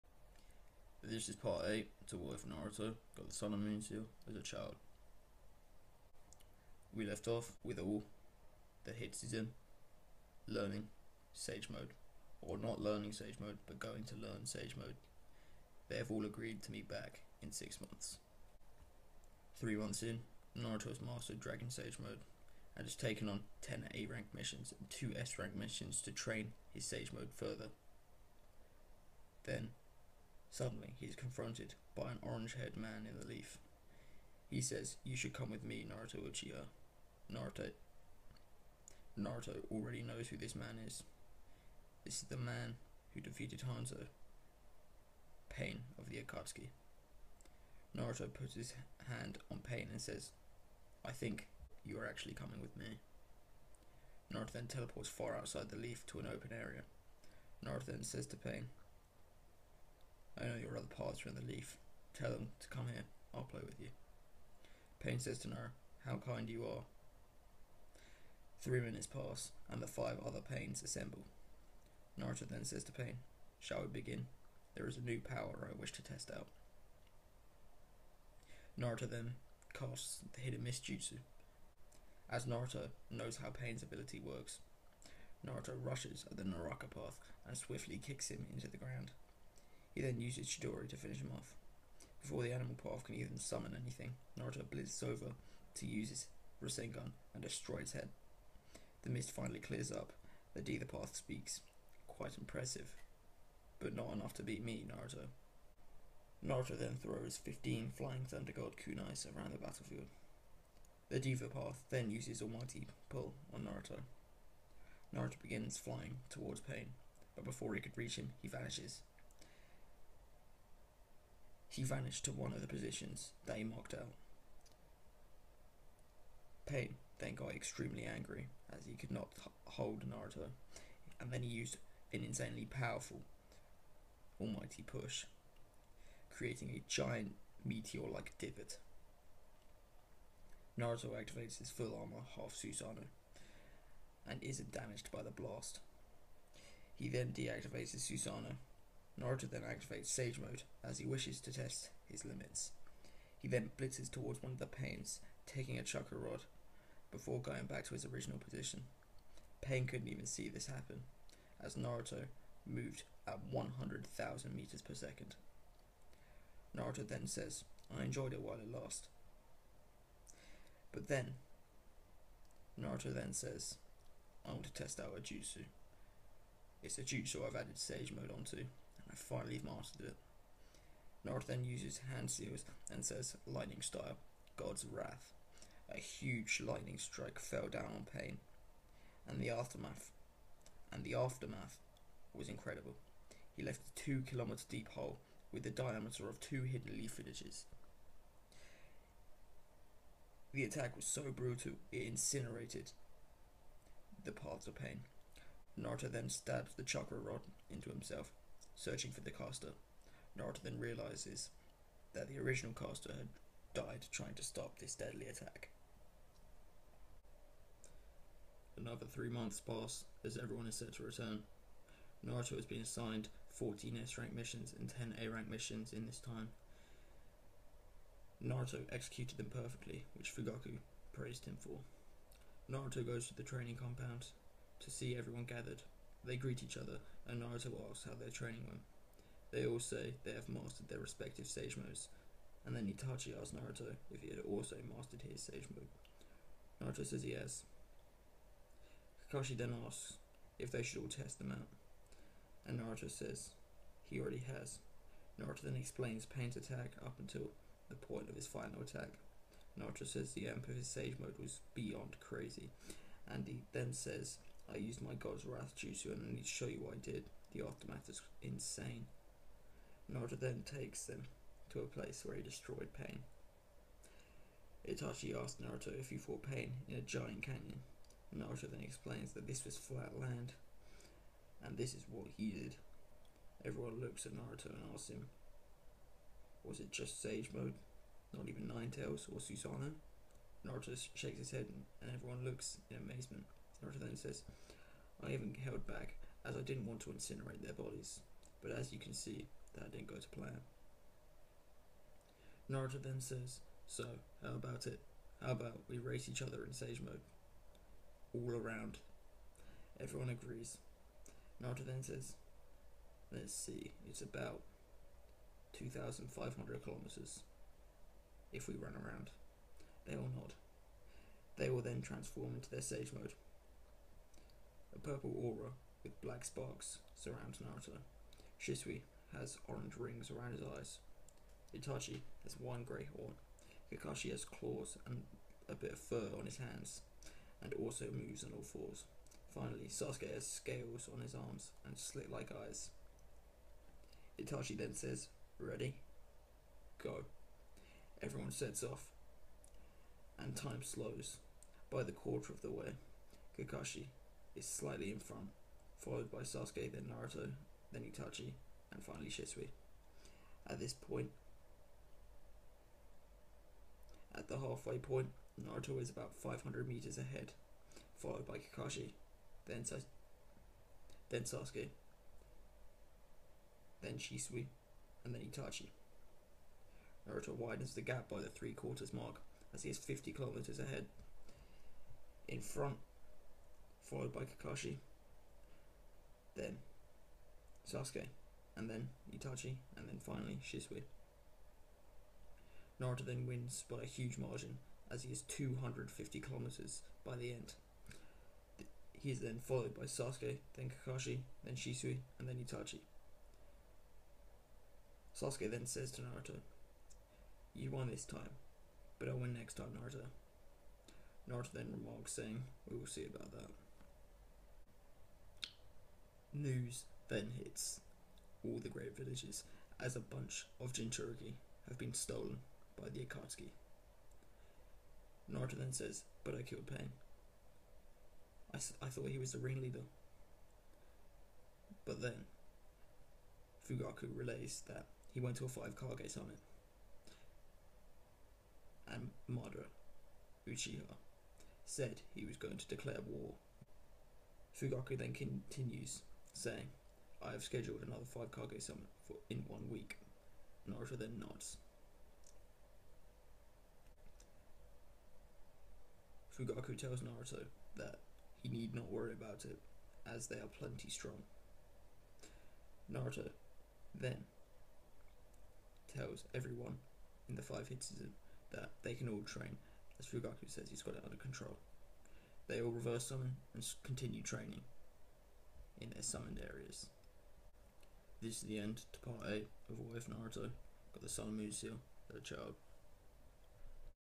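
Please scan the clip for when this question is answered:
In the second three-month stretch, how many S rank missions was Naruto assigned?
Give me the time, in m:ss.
3:43.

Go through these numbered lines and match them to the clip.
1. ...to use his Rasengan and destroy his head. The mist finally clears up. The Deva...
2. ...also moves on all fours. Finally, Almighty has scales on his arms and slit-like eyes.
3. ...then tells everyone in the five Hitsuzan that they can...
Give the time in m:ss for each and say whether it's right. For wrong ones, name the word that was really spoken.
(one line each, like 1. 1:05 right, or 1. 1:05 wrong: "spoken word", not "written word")
1. 1:35 right
2. 5:37 wrong: "Sasuke", not "Almighty"
3. 7:44 right.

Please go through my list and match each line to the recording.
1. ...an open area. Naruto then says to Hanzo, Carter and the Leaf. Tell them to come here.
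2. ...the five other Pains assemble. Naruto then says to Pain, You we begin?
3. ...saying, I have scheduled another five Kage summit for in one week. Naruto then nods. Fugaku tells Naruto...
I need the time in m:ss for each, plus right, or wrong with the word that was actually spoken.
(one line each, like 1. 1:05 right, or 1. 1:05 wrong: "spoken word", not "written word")
1. 0:56 wrong: "Pain", not "Hanzo"
2. 1:09 wrong: "Shall", not "You"
3. 7:26 right.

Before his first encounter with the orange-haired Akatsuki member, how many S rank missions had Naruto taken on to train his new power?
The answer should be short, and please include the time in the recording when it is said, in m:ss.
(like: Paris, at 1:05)
2, at 0:24.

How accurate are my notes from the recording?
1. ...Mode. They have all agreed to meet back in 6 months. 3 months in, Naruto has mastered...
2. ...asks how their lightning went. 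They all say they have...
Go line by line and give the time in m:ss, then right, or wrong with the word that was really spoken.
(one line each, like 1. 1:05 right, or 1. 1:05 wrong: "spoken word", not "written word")
1. 0:14 right
2. 3:57 wrong: "training", not "lightning".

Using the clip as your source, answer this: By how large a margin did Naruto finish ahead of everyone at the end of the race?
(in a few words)
250 kilometers.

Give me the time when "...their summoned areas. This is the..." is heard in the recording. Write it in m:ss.
7:56.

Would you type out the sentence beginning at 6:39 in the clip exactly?
He is then followed by Sasuke, then Kakashi, then Shisui, and then Itachi.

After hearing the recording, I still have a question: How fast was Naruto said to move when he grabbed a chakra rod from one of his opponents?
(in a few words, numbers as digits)
100,000 meters per second.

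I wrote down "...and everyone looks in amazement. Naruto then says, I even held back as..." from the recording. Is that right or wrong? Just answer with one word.
right.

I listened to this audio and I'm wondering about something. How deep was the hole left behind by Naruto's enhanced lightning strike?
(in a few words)
2 kilometers.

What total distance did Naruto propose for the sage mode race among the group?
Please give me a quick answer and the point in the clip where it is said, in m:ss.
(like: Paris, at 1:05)
2,500 kilometers, at 5:15.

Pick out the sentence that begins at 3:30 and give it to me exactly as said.
Naruto then realizes that the original caster had died trying to stop this deadly attack.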